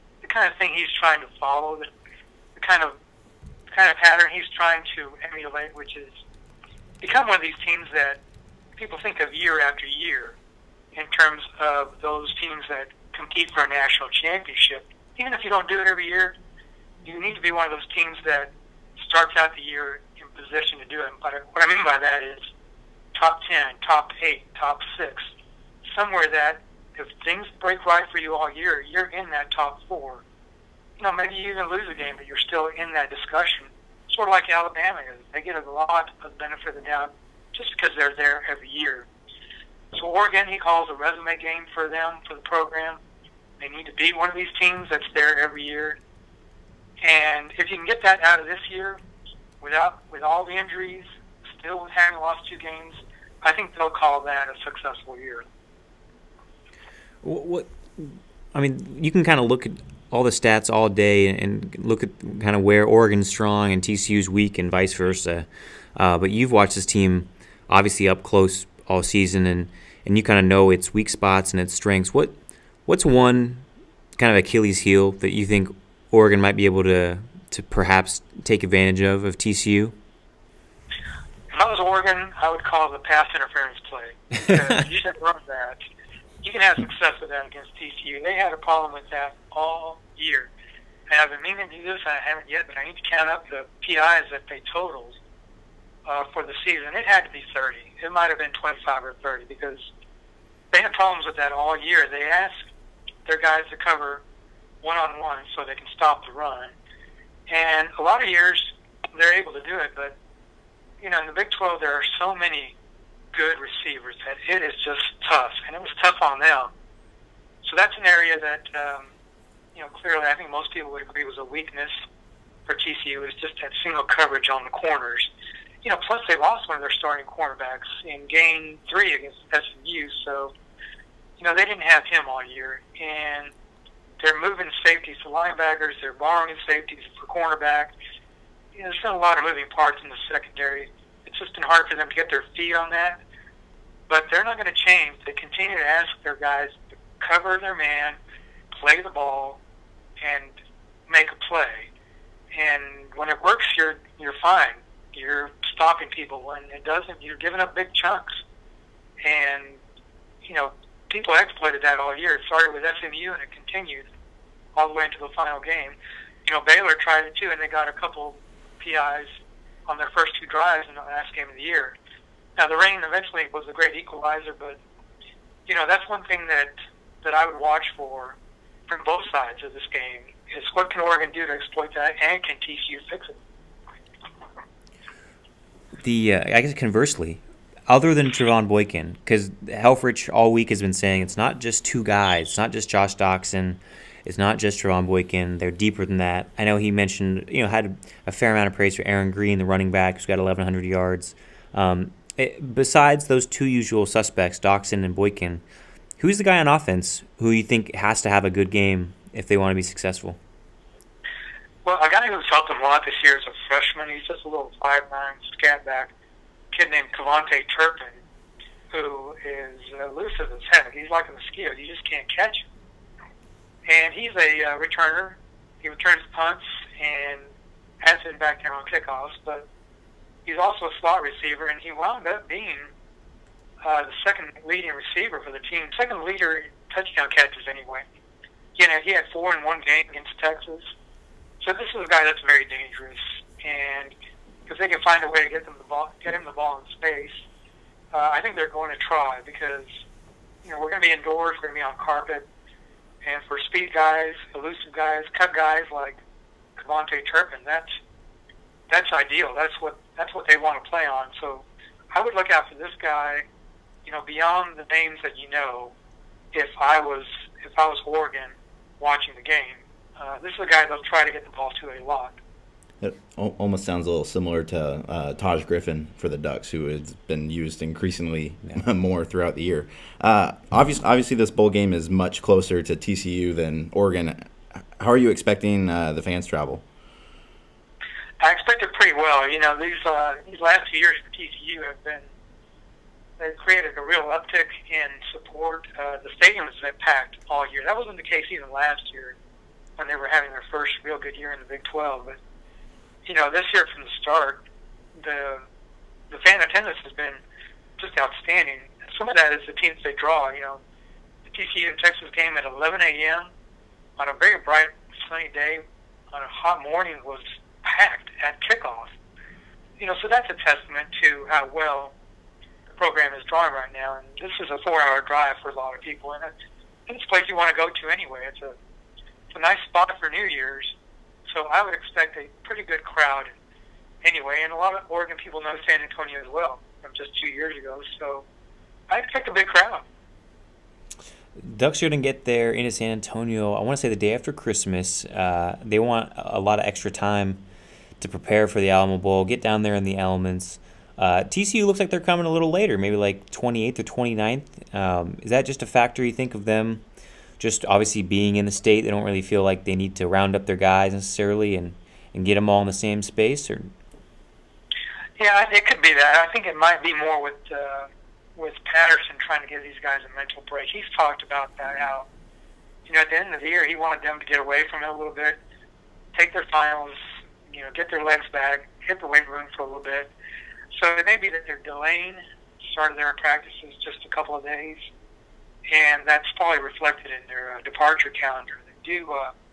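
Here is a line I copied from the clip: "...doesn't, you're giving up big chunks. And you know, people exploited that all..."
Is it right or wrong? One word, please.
right.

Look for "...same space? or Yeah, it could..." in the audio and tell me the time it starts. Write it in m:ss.
6:02.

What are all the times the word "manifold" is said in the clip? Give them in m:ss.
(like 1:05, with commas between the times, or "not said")
not said.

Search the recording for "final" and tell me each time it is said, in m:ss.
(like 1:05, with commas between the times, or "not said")
2:45, 6:16.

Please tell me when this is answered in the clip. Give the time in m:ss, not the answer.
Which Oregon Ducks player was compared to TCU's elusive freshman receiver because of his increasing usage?
4:35.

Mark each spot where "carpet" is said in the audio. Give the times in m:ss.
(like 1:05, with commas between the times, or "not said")
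4:11.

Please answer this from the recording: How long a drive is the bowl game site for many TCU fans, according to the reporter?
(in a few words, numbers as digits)
4 hours.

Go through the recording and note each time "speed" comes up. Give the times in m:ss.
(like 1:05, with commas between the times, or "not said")
4:13.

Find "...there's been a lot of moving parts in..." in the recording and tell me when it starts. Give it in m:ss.
2:18.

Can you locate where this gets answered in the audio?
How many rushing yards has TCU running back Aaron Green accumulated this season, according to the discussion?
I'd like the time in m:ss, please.
3:20.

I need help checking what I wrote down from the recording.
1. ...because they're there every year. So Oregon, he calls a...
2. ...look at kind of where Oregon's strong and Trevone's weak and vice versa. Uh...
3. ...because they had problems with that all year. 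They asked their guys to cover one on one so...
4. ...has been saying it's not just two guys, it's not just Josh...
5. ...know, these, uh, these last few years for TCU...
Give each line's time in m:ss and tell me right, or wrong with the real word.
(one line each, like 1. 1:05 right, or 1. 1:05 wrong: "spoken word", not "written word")
1. 0:37 right
2. 1:01 wrong: "TCU", not "Trevone"
3. 1:39 right
4. 3:10 right
5. 4:49 right.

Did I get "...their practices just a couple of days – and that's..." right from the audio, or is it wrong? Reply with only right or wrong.
right.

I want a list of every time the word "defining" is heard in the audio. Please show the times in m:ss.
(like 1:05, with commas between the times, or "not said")
not said.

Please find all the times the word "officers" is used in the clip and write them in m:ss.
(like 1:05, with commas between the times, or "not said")
not said.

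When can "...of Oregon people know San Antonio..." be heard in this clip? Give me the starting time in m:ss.
5:34.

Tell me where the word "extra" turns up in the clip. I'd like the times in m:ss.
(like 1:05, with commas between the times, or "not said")
5:46.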